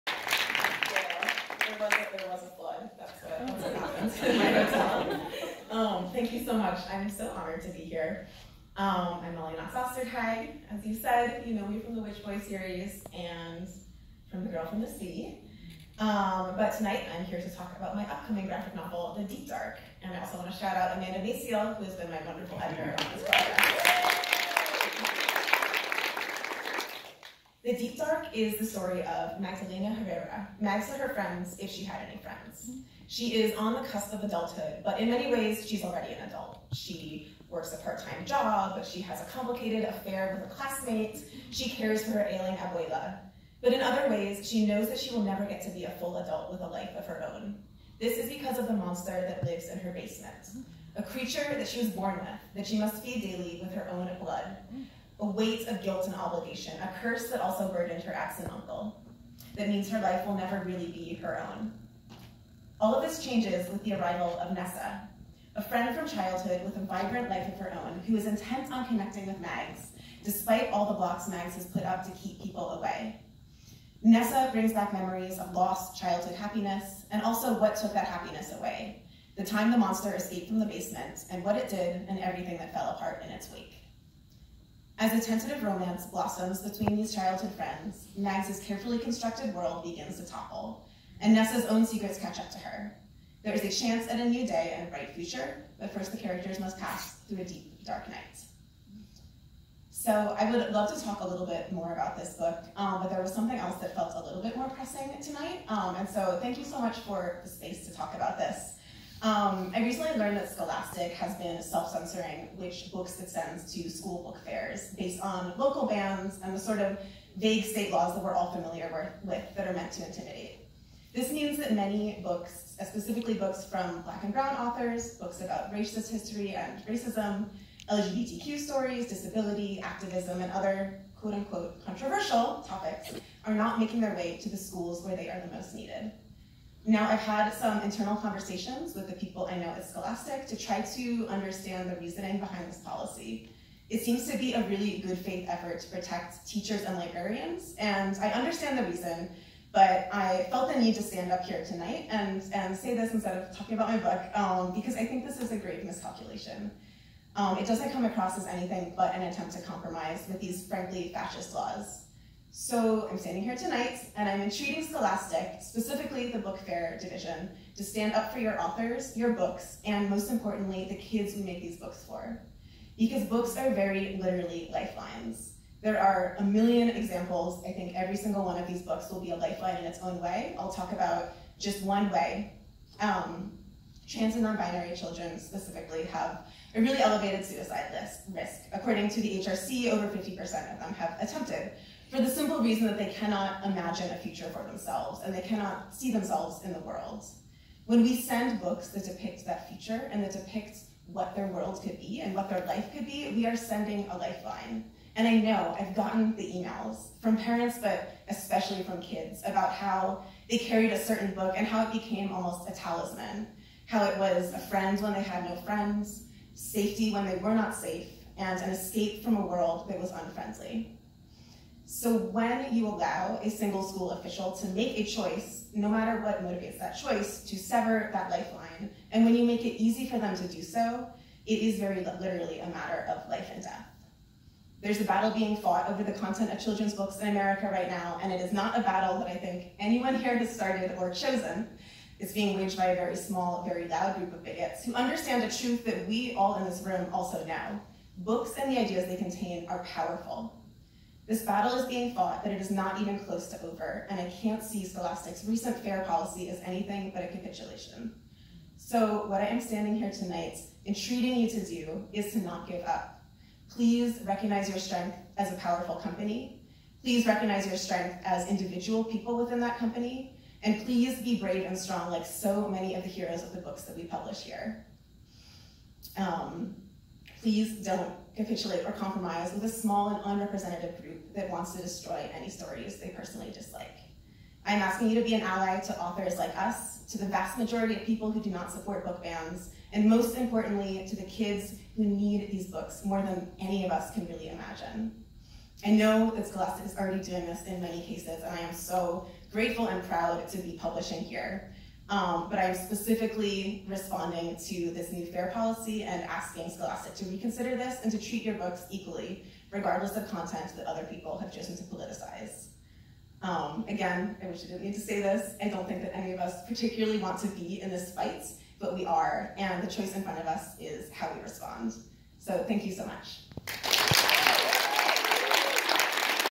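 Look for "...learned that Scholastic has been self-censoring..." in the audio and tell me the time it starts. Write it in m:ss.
1:50.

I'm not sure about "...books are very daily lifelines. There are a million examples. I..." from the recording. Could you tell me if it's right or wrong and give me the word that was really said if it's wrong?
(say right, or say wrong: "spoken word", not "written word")
wrong: "literally", not "daily".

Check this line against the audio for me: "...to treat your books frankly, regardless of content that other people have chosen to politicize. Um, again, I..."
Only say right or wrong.
wrong.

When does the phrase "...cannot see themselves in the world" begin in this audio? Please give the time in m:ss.
3:15.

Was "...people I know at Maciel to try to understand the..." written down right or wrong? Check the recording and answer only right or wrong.
wrong.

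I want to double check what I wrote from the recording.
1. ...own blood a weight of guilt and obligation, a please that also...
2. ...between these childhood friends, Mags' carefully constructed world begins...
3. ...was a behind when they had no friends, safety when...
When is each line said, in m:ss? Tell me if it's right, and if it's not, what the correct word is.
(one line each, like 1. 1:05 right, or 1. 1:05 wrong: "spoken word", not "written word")
1. 0:53 wrong: "curse", not "please"
2. 1:26 right
3. 3:34 wrong: "friend", not "behind".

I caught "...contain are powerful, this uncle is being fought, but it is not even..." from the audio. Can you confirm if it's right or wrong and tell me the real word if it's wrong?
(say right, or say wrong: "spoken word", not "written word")
wrong: "battle", not "uncle".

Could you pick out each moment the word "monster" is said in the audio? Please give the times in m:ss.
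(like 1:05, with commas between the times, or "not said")
0:48, 1:19.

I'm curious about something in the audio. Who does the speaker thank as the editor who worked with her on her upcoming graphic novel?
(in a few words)
Amanda Maciel.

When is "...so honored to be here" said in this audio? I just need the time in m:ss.
0:07.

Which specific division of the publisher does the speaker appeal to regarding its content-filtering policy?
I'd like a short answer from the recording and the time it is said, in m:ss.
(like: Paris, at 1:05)
Book Fair division, at 2:46.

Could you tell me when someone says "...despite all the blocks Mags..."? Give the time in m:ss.
1:10.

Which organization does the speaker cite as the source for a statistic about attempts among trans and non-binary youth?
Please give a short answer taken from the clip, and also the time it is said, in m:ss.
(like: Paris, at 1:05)
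HRC, at 3:09.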